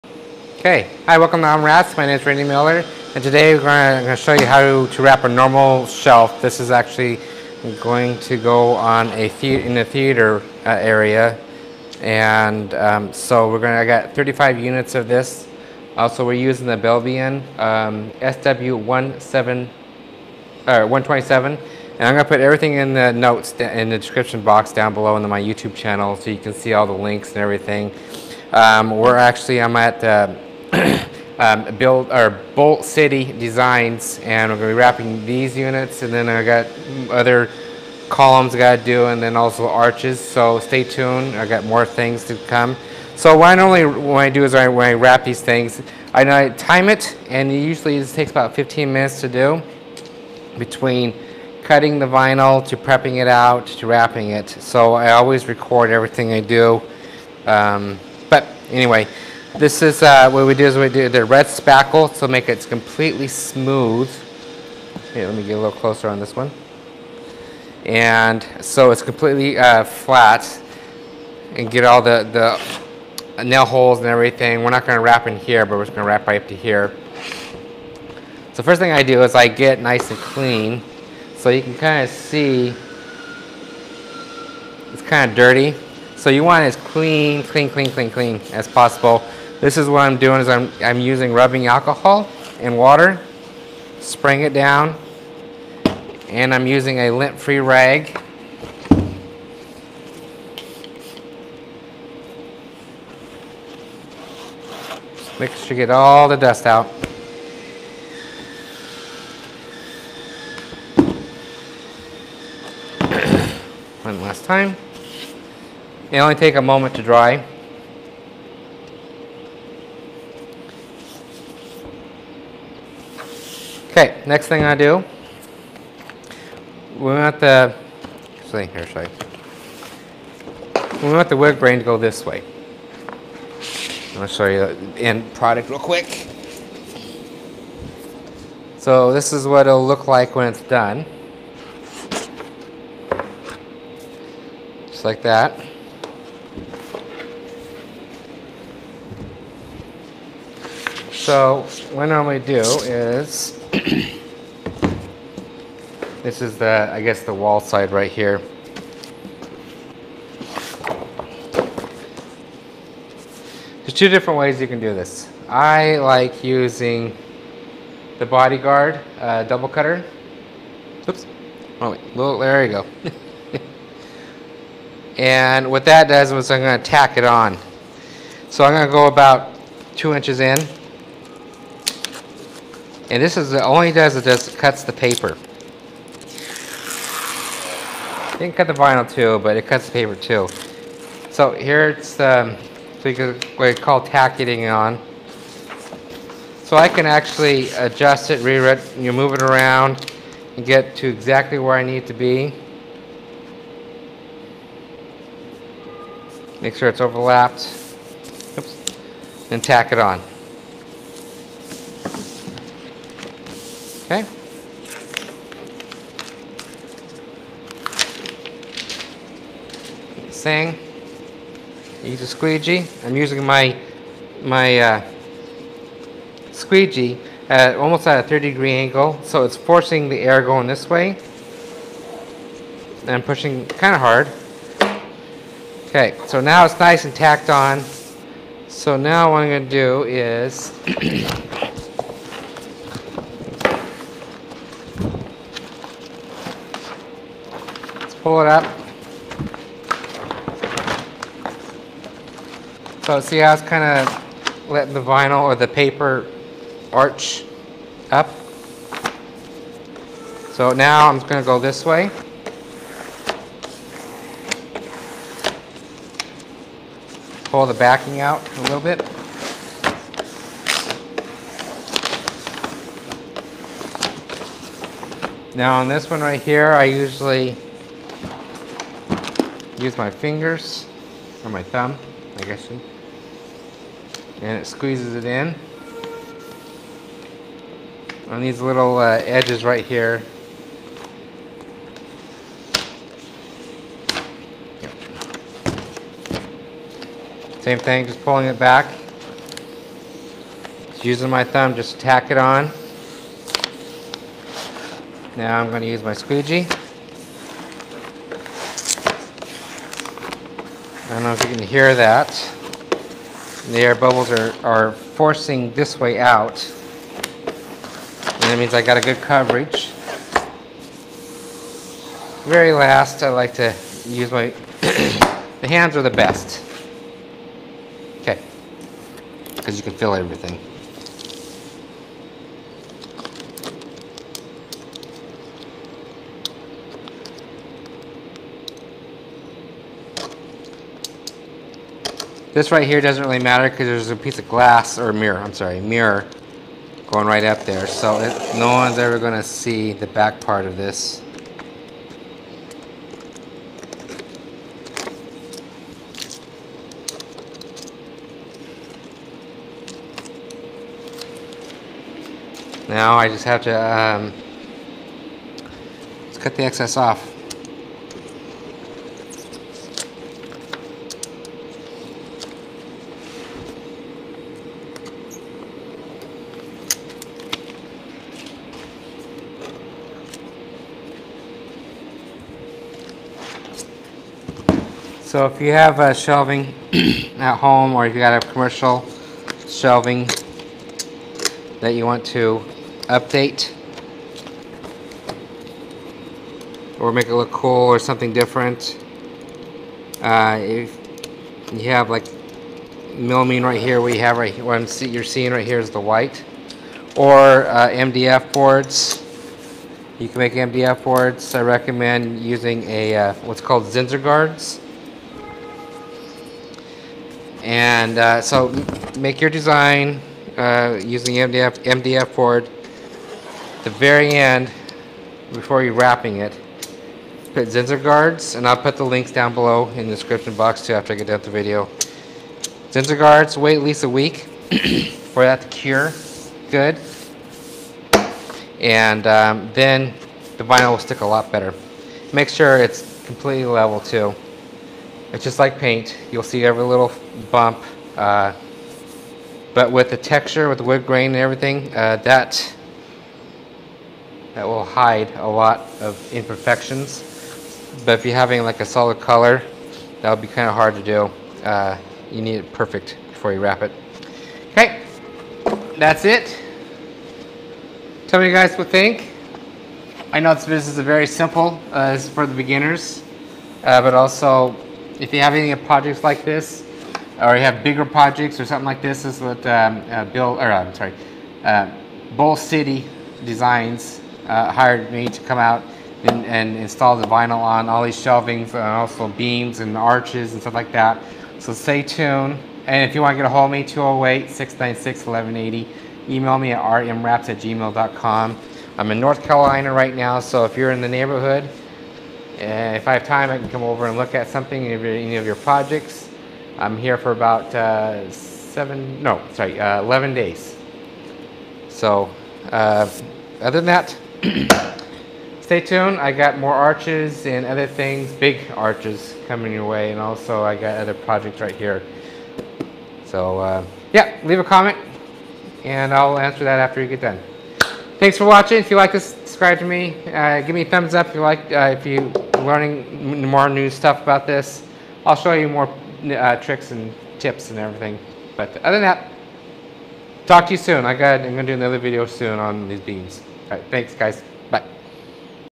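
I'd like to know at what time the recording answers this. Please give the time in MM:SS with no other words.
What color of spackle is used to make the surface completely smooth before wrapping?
01:01.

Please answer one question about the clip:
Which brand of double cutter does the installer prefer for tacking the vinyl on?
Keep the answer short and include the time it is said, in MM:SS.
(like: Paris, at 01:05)
Bodyguard, at 02:48.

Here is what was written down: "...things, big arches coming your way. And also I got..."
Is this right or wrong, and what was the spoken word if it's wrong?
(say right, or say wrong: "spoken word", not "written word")
right.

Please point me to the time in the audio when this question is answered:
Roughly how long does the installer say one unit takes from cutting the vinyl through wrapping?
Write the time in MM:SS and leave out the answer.
00:48.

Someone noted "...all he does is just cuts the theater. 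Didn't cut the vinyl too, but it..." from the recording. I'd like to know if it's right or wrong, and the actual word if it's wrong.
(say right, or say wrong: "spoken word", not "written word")
wrong: "paper", not "theater".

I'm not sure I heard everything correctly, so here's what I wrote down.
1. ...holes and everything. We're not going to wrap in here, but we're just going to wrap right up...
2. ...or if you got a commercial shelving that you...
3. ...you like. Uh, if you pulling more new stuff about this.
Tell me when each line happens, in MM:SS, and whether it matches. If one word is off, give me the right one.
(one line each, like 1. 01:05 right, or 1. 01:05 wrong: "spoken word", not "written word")
1. 01:13 right
2. 06:27 right
3. 08:51 wrong: "learning", not "pulling".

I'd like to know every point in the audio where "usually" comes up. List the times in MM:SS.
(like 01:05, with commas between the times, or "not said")
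00:47, 04:36.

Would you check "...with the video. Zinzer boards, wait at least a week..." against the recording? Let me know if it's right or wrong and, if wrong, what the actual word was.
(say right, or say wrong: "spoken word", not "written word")
wrong: "guards", not "boards".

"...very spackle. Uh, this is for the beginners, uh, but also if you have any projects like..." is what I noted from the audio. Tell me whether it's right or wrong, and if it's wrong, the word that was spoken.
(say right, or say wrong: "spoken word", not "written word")
wrong: "simple", not "spackle".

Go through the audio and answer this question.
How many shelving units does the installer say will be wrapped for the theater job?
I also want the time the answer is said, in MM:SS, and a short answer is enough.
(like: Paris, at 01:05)
35, at 00:14.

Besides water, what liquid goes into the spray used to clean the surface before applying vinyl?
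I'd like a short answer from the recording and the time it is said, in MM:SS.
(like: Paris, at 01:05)
Rubbing alcohol, at 01:31.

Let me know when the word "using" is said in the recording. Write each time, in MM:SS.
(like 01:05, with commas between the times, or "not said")
00:16, 01:30, 01:36, 02:46, 03:43, 05:01, 06:52, 07:01.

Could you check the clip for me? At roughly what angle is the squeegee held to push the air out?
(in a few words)
30 degrees.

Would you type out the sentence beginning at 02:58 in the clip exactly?
So I'm going to go about two inches in.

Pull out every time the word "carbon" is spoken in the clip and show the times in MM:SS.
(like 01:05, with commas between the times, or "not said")
not said.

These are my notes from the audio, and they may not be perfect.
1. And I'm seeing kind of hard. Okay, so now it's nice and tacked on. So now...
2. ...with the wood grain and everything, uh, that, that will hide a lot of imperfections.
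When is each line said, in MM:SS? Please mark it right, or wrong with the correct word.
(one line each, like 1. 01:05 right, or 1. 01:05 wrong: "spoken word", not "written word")
1. 03:53 wrong: "pushing", not "seeing"
2. 07:30 right.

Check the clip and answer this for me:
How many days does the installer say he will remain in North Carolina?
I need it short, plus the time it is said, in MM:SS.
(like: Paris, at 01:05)
11, at 08:30.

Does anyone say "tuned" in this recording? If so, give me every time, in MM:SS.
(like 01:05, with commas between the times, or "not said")
00:40, 08:12, 08:35.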